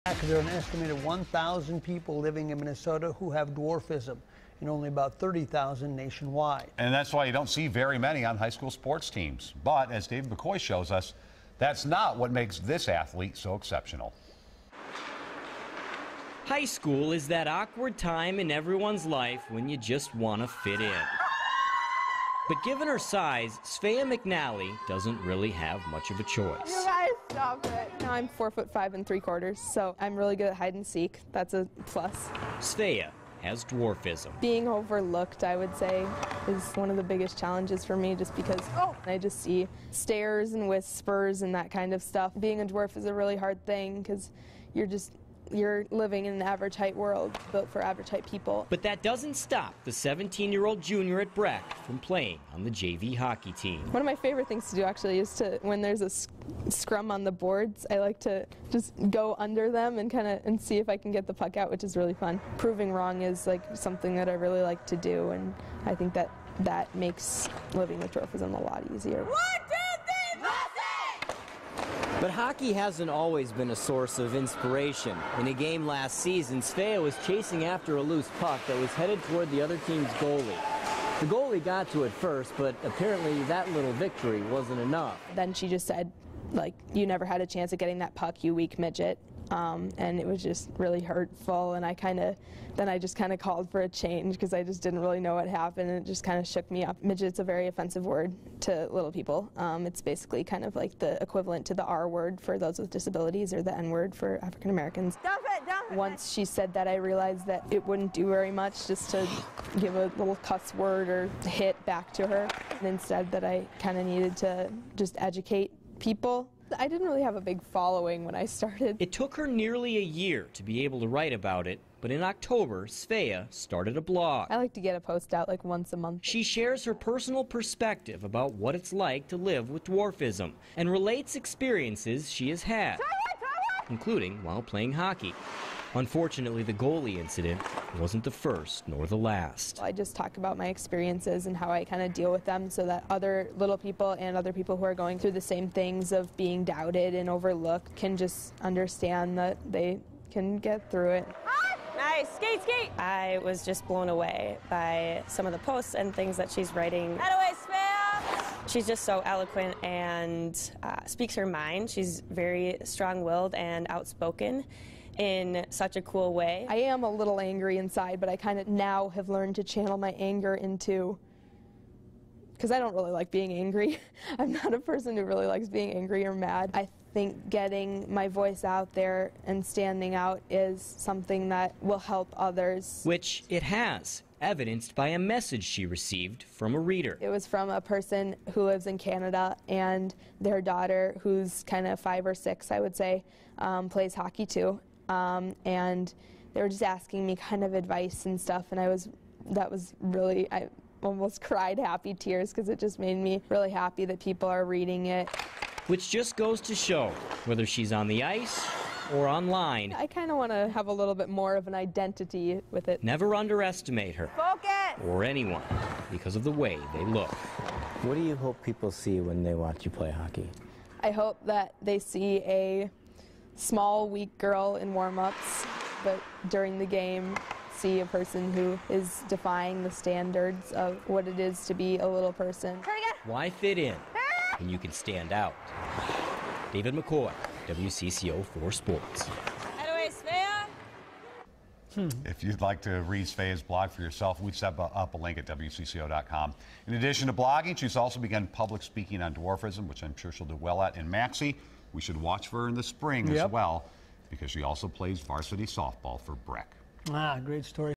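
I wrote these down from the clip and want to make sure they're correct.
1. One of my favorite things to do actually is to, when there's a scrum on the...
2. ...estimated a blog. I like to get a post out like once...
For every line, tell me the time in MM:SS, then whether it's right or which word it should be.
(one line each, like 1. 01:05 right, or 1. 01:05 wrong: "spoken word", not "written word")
1. 00:53 right
2. 02:03 wrong: "started", not "estimated".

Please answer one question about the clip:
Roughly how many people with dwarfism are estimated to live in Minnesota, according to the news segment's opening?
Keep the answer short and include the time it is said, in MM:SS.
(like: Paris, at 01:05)
1,000, at 00:01.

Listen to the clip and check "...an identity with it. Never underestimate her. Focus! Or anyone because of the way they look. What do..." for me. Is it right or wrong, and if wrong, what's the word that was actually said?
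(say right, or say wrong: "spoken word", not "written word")
right.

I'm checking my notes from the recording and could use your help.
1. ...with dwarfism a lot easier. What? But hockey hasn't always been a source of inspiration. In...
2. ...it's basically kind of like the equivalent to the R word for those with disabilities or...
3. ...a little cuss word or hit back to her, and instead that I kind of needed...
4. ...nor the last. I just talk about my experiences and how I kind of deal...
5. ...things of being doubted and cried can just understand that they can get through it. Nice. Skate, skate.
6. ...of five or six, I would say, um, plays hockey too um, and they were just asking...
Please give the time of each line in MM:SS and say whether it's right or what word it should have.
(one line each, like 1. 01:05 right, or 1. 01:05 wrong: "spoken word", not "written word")
1. 01:07 right
2. 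01:39 right
3. 01:49 right
4. 02:18 right
5. 02:25 wrong: "overlooked", not "cried"
6. 03:11 right.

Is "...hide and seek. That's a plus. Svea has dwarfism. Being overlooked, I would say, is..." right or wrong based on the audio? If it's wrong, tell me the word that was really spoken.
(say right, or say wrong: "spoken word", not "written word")
right.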